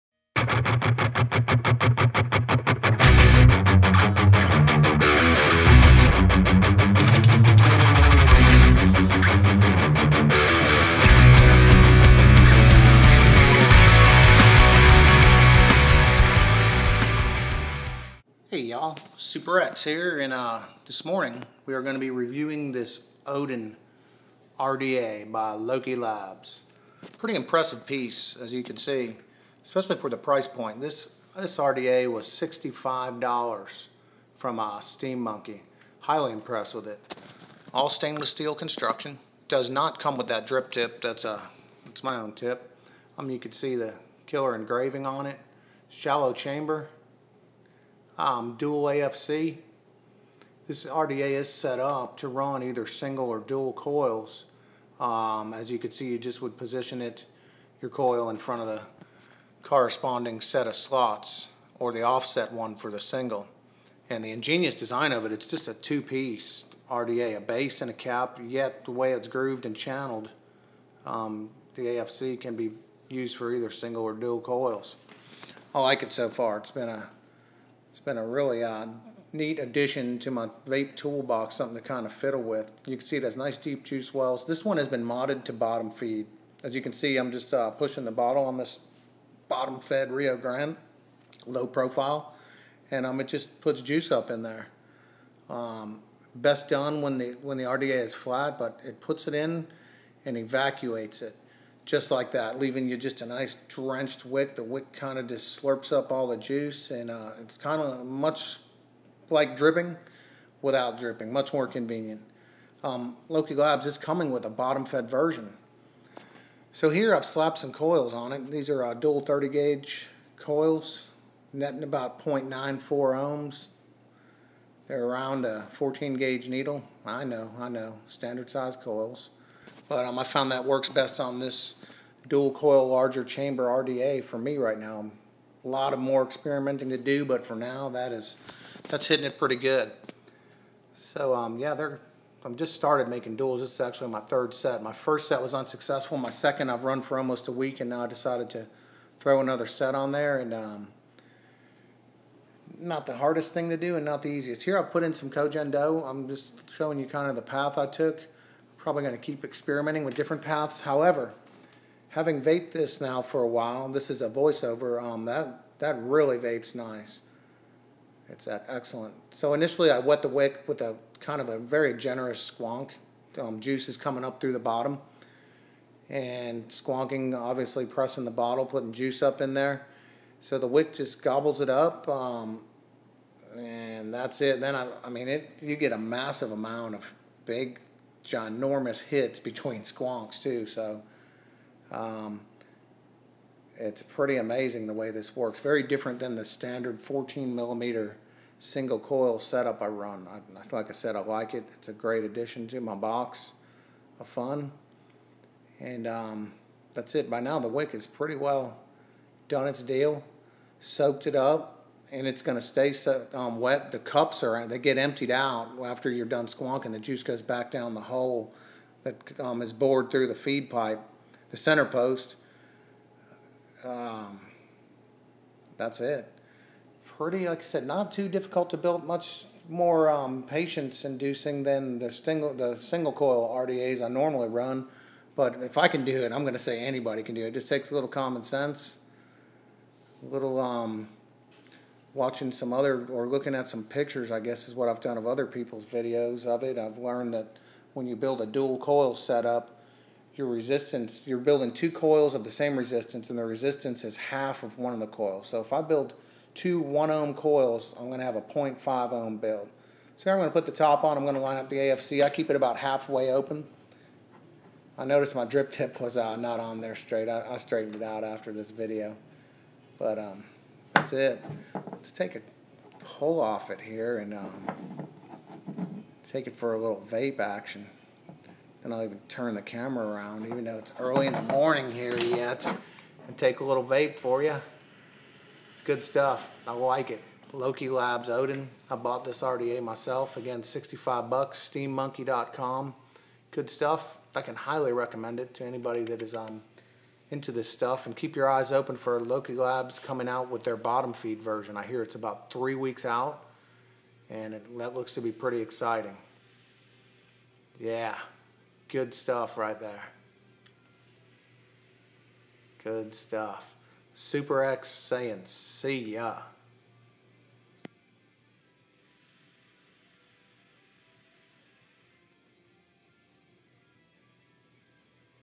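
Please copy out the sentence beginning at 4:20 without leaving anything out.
So here I'm going to put the top on, I'm going to line up the AFC.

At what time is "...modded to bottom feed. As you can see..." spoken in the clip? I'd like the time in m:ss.
1:25.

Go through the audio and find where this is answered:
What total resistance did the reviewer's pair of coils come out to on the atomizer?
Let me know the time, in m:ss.
2:02.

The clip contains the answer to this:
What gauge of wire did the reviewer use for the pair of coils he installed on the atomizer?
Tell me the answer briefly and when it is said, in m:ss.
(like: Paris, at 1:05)
30 gauge, at 1:59.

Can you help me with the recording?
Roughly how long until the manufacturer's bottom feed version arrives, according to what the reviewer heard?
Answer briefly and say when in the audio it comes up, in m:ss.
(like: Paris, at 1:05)
About three weeks, at 5:02.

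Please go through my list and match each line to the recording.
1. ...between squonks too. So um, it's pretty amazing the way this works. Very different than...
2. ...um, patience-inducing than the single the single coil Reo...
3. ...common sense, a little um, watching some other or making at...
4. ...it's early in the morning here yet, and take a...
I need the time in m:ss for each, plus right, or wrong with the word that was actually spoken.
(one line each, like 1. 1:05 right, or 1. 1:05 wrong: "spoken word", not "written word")
1. 3:09 right
2. 3:50 wrong: "RDAs", not "Reo"
3. 3:58 wrong: "looking", not "making"
4. 4:40 right.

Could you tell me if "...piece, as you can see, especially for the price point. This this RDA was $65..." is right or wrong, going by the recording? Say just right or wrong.
right.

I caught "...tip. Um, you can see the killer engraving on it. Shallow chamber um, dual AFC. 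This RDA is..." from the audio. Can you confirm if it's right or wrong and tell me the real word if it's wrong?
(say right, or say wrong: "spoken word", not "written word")
right.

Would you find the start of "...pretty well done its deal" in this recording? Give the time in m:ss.
3:28.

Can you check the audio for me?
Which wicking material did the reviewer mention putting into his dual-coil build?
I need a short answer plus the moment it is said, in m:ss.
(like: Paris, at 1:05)
Kojen, at 2:35.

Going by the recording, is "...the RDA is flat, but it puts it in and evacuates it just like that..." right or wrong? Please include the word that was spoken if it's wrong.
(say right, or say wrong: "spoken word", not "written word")
right.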